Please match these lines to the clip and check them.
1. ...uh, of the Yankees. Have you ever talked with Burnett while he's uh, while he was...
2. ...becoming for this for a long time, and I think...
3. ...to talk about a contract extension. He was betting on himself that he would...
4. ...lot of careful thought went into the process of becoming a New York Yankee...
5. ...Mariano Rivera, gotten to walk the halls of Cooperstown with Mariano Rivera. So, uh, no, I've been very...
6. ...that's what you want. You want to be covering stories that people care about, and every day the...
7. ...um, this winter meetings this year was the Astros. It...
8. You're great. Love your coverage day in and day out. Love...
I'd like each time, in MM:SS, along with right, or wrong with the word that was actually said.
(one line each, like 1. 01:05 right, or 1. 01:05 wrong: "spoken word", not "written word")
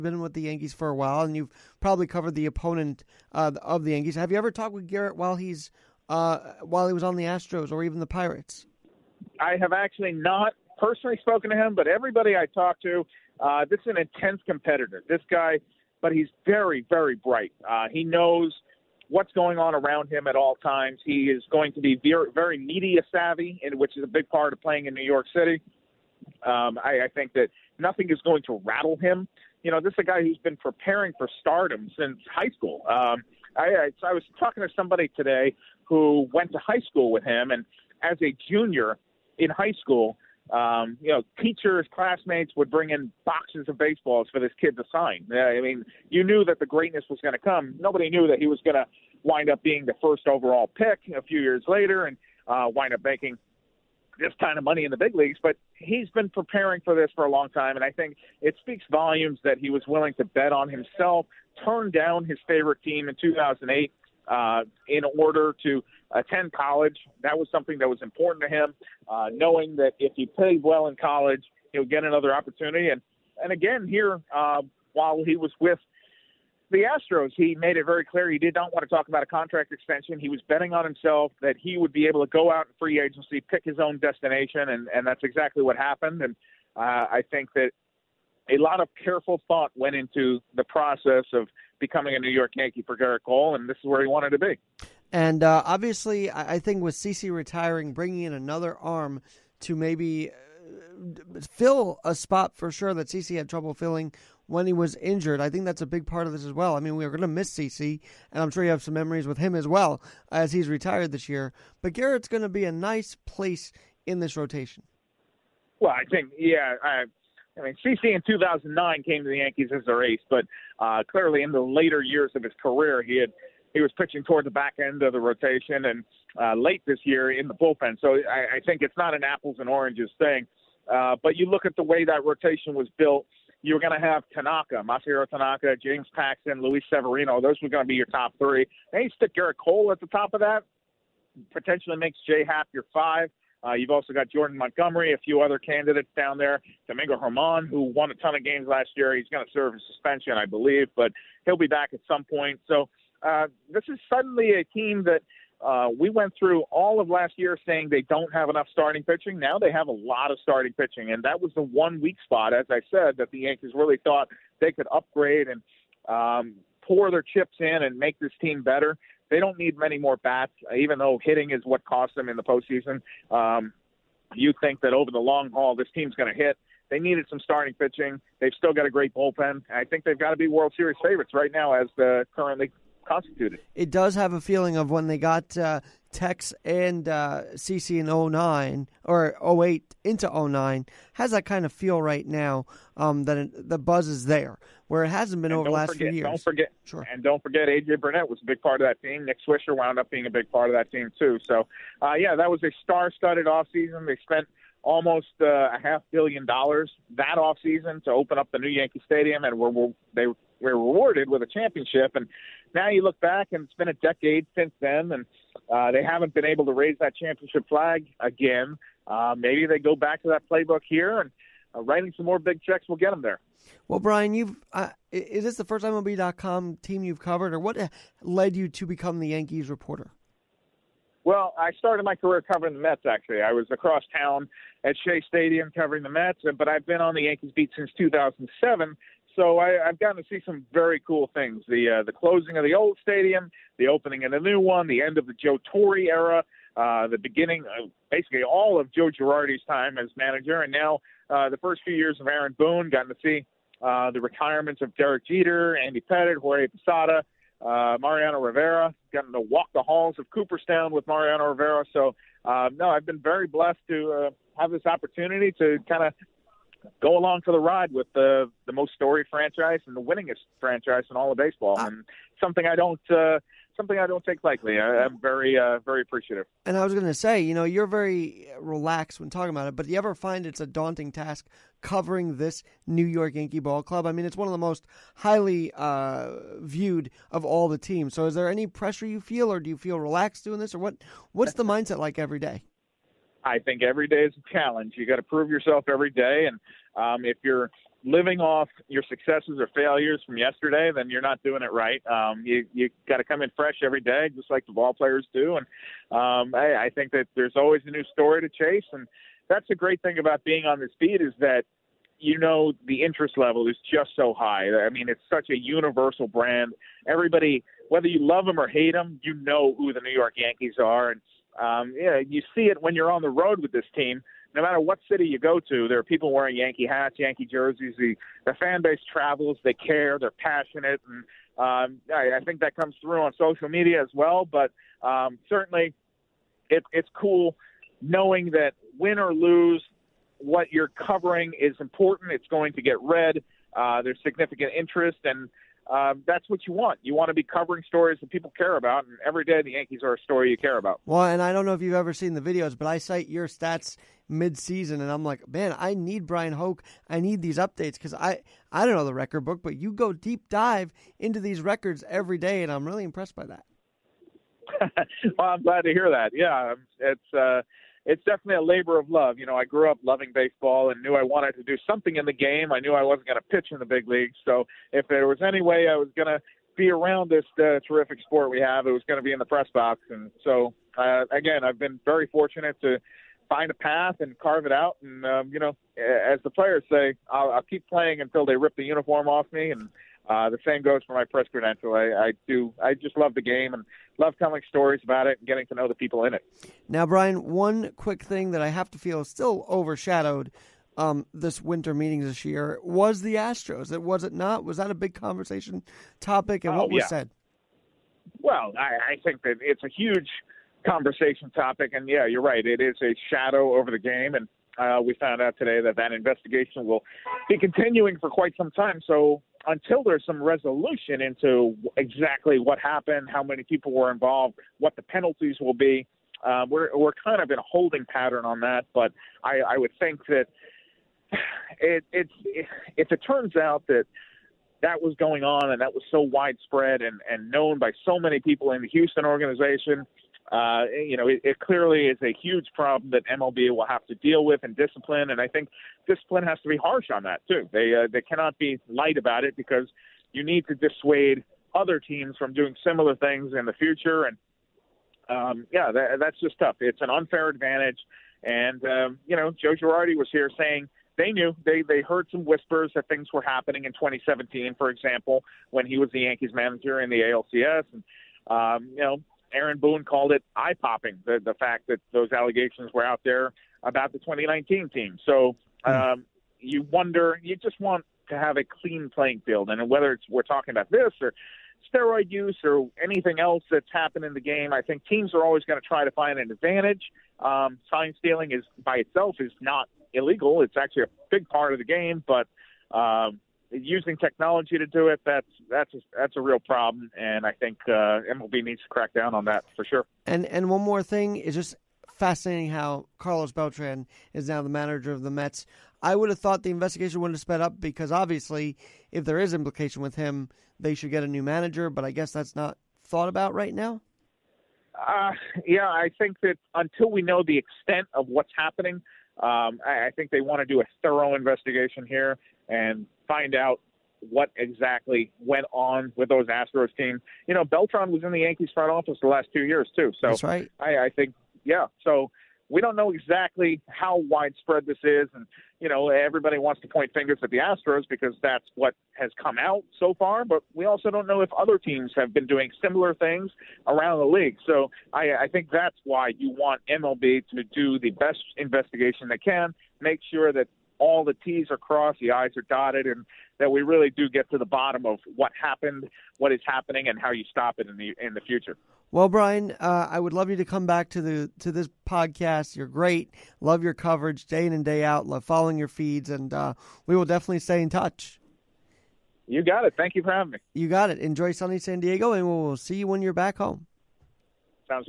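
1. 00:03 wrong: "Gerrit", not "Burnett"
2. 00:56 wrong: "preparing", not "becoming"
3. 01:18 right
4. 01:28 right
5. 04:18 right
6. 05:46 right
7. 06:40 right
8. 09:22 right.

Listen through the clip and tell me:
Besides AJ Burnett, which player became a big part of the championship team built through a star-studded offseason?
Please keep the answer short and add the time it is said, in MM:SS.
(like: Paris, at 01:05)
Nick Swisher, at 03:19.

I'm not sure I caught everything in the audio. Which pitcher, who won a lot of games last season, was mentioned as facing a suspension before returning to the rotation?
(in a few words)
Domingo Germán.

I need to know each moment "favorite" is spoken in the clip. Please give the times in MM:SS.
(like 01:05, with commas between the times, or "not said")
01:02, 03:01.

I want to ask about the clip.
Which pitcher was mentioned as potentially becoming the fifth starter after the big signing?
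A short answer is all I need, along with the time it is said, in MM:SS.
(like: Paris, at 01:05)
Jay Happ, at 02:22.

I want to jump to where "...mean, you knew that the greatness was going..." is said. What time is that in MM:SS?
00:45.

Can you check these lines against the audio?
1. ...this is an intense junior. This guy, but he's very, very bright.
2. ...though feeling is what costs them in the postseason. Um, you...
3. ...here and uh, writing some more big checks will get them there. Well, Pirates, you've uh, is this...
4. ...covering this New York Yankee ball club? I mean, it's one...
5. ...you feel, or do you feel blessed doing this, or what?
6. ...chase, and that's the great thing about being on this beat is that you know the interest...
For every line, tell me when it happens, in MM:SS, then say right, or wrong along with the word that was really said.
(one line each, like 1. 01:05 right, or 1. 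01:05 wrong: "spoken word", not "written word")
1. 00:13 wrong: "competitor", not "junior"
2. 02:50 wrong: "hitting", not "feeling"
3. 03:40 wrong: "Bryan", not "Pirates"
4. 04:41 right
5. 04:49 wrong: "relaxed", not "blessed"
6. 05:08 right.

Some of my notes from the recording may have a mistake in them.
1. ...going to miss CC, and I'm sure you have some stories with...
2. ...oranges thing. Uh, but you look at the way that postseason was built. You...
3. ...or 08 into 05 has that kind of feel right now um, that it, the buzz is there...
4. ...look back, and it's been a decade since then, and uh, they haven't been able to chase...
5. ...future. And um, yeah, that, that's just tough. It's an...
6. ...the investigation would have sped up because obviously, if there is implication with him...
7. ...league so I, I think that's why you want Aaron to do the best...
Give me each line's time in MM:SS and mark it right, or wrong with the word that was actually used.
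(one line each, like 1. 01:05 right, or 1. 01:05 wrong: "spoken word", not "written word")
1. 01:47 wrong: "memories", not "stories"
2. 02:09 wrong: "rotation", not "postseason"
3. 03:09 wrong: "09", not "05"
4. 03:33 wrong: "raise", not "chase"
5. 07:33 right
6. 08:26 right
7. 09:04 wrong: "MLB", not "Aaron".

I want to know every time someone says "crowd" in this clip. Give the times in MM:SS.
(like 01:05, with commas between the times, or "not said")
not said.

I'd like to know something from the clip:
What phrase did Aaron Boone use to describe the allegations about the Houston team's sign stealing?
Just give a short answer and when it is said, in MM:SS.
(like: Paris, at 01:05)
eye popping, at 07:50.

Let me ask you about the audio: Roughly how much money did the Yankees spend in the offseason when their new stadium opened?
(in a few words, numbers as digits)
half billion dollars.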